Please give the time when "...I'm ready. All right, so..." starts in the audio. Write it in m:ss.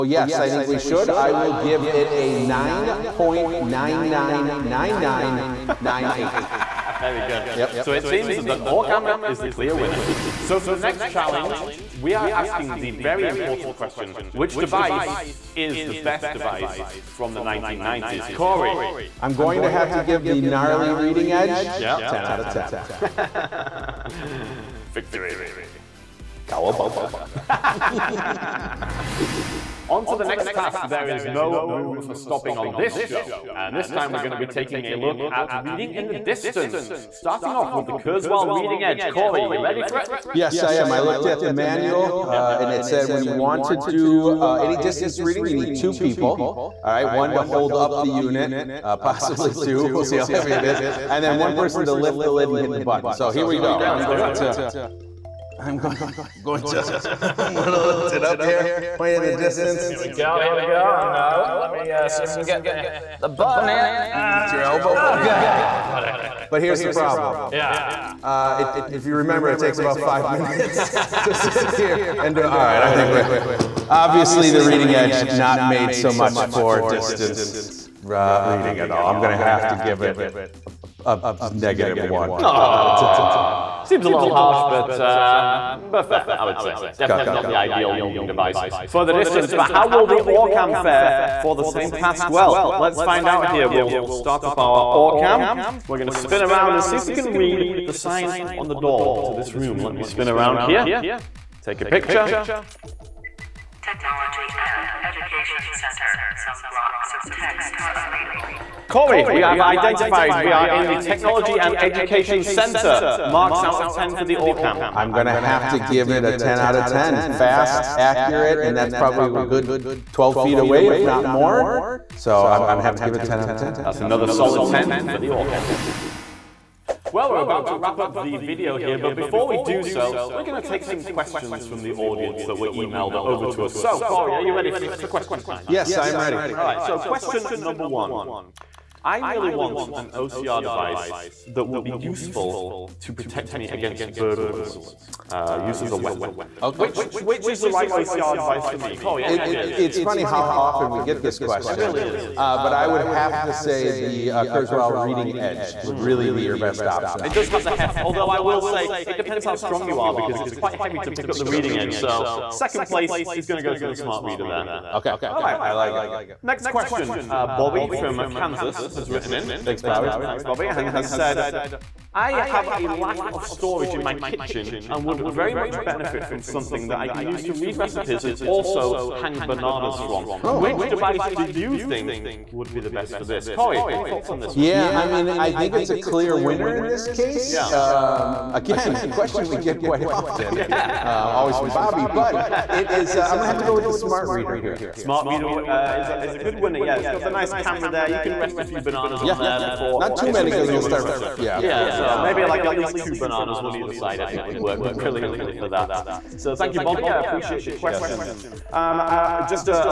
2:15.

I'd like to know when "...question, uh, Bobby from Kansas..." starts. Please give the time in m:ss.
2:46.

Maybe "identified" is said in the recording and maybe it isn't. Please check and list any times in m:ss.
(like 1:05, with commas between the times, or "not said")
1:49.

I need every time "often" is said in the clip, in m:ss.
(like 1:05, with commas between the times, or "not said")
2:30, 3:10.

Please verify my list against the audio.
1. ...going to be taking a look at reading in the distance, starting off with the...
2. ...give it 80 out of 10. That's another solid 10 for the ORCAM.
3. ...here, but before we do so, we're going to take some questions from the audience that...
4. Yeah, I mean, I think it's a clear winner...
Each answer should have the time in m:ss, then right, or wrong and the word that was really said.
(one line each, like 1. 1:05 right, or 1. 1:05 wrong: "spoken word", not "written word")
1. 0:34 right
2. 2:03 wrong: "10", not "80"
3. 2:08 right
4. 3:04 right.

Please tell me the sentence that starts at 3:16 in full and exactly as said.
It's got the nice camera there.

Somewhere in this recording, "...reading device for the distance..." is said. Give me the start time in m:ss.
1:27.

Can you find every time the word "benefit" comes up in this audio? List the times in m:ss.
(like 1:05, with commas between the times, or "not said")
2:55.